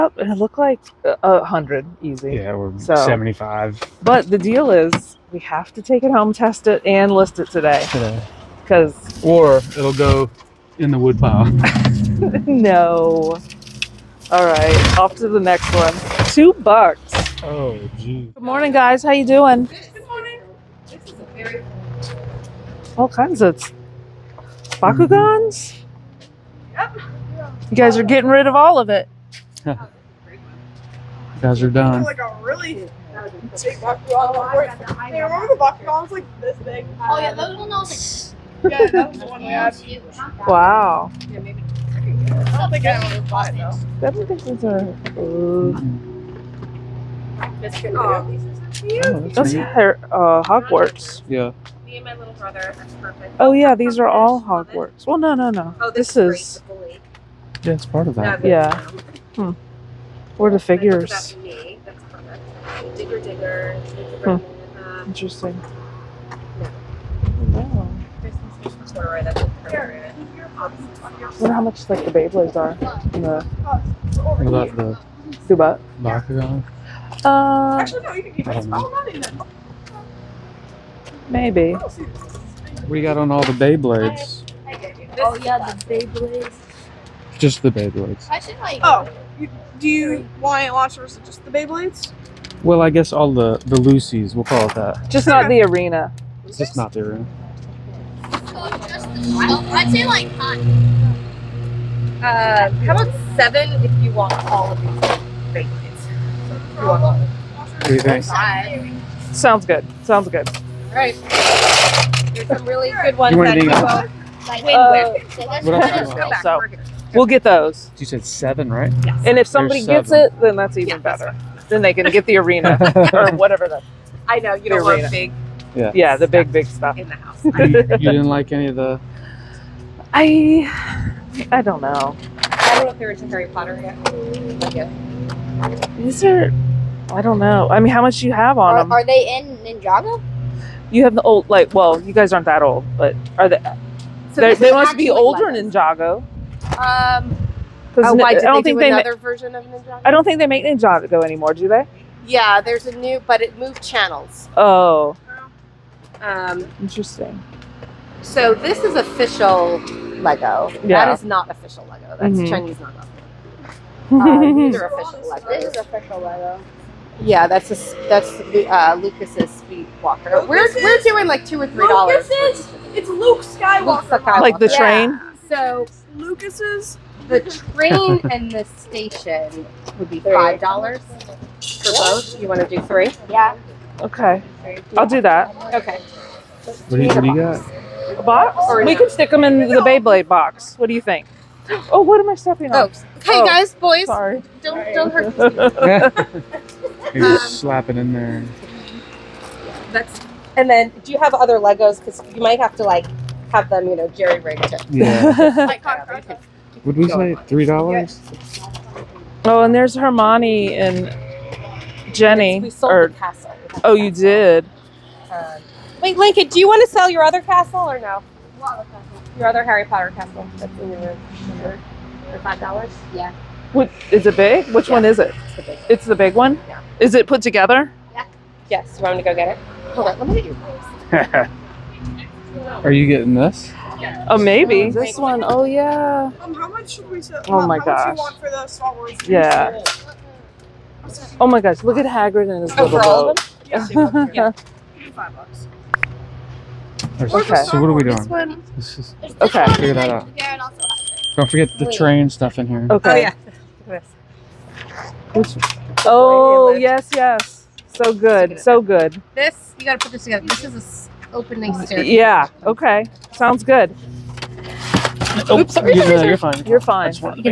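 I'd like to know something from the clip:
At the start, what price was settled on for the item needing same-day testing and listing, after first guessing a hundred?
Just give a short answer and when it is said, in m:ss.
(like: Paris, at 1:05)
75, at 0:02.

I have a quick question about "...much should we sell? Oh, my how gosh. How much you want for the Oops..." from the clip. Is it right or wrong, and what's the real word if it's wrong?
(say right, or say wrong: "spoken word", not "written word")
wrong: "Star", not "Oops".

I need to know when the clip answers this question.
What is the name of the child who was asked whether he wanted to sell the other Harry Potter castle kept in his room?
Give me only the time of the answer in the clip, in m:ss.
3:36.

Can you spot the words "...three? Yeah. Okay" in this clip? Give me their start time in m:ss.
3:02.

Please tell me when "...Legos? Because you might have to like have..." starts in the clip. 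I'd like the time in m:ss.
3:21.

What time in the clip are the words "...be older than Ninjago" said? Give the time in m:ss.
2:24.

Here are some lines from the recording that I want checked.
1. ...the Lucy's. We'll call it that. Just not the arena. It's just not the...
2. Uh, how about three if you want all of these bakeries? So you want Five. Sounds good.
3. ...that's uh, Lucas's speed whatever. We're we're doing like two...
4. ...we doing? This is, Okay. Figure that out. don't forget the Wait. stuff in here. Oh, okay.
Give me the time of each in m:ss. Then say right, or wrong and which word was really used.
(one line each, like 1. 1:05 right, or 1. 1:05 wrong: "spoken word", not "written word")
1. 1:33 right
2. 1:42 wrong: "seven", not "three"
3. 2:48 wrong: "walker", not "whatever"
4. 4:07 right.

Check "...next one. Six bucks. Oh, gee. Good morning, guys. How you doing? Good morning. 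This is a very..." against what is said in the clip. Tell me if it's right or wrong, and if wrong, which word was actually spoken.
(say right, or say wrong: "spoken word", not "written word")
wrong: "Two", not "Six".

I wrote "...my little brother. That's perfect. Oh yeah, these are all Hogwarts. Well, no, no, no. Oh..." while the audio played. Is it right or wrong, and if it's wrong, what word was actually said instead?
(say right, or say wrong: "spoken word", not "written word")
right.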